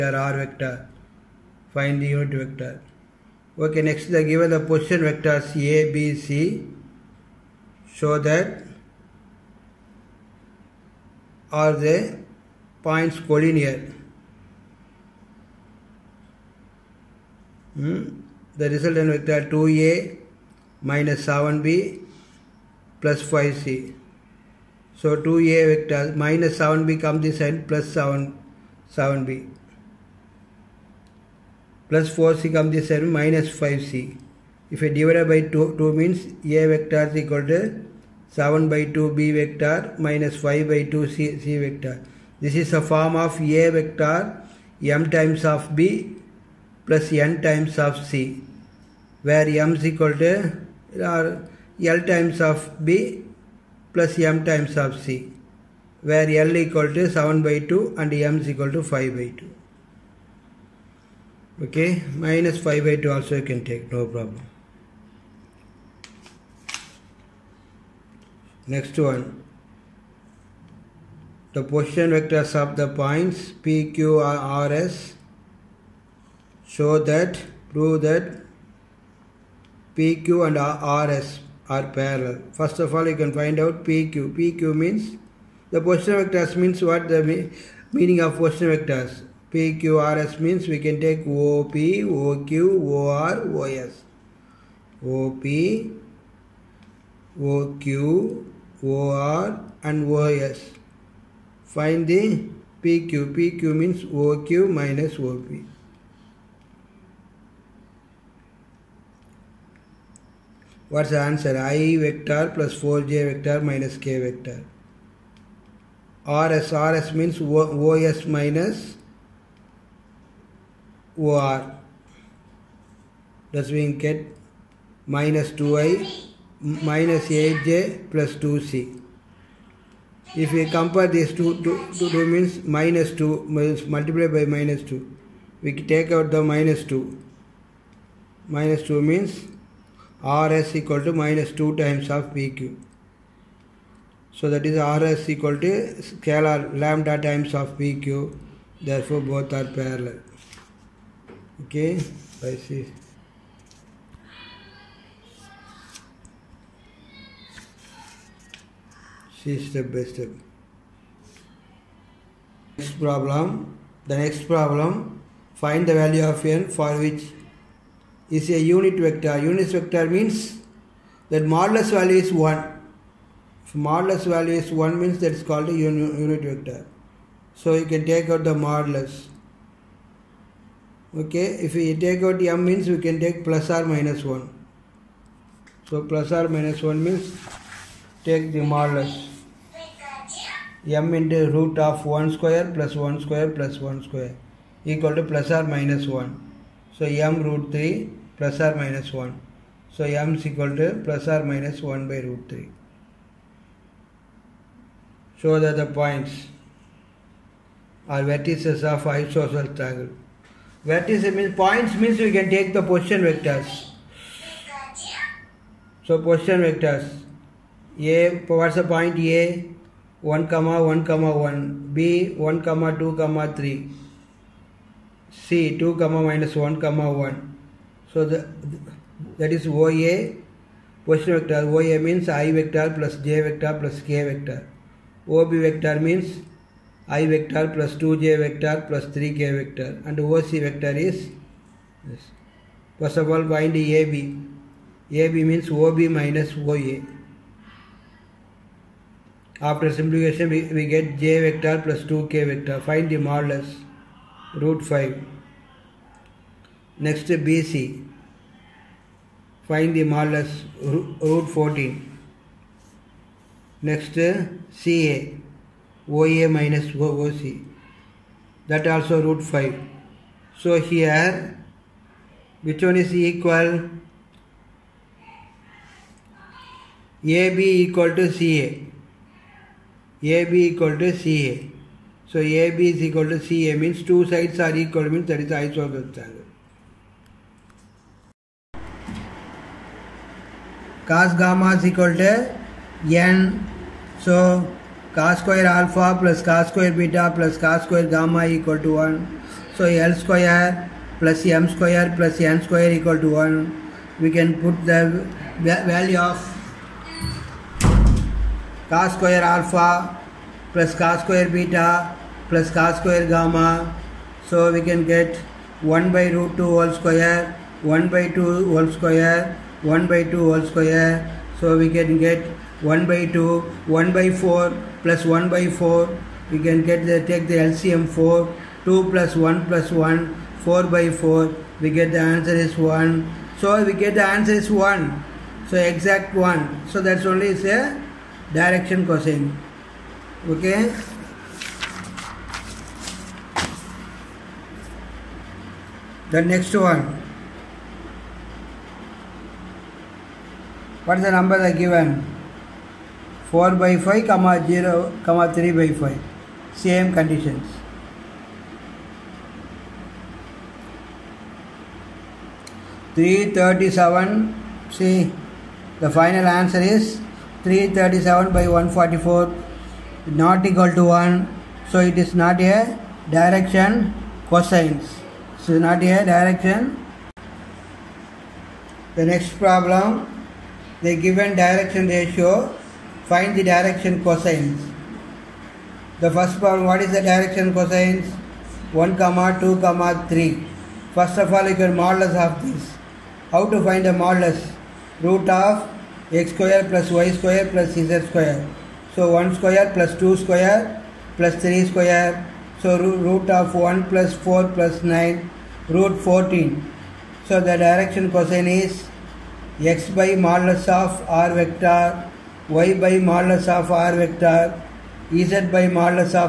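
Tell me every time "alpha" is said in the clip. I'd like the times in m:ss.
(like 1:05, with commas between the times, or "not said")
4:55, 5:09.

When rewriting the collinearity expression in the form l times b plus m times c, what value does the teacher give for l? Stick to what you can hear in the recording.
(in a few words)
7/2.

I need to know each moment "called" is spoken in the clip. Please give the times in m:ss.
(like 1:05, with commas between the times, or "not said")
2:55.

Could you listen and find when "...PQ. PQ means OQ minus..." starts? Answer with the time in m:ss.
1:42.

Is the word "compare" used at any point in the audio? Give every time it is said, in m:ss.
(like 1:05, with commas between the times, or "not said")
2:10.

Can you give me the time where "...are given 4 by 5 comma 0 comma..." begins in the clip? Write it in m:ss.
5:51.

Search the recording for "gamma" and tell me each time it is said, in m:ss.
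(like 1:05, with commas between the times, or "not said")
4:51, 4:58, 5:13.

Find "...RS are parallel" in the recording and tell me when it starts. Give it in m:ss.
1:21.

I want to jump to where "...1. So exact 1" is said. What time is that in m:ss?
5:34.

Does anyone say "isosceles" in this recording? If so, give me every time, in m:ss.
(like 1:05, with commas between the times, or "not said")
3:29, 4:45.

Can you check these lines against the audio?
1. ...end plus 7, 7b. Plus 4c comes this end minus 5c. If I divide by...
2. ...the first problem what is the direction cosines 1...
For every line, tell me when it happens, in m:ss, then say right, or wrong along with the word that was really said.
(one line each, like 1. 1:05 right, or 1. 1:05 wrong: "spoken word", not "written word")
1. 0:27 right
2. 6:26 right.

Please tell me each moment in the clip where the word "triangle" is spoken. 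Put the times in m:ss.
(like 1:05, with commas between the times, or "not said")
3:29, 4:46.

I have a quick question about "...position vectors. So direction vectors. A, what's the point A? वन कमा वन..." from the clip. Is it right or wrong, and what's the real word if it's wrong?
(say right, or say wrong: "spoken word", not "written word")
wrong: "position", not "direction".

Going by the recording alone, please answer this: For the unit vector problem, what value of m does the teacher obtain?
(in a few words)
plus or minus 1/root 3.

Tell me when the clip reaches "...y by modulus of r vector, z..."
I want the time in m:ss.
6:52.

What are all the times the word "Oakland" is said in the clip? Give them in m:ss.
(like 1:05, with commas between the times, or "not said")
not said.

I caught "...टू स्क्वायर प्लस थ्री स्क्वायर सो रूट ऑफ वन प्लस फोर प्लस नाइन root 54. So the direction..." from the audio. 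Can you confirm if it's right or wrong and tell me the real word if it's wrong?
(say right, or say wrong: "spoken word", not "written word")
wrong: "14", not "54".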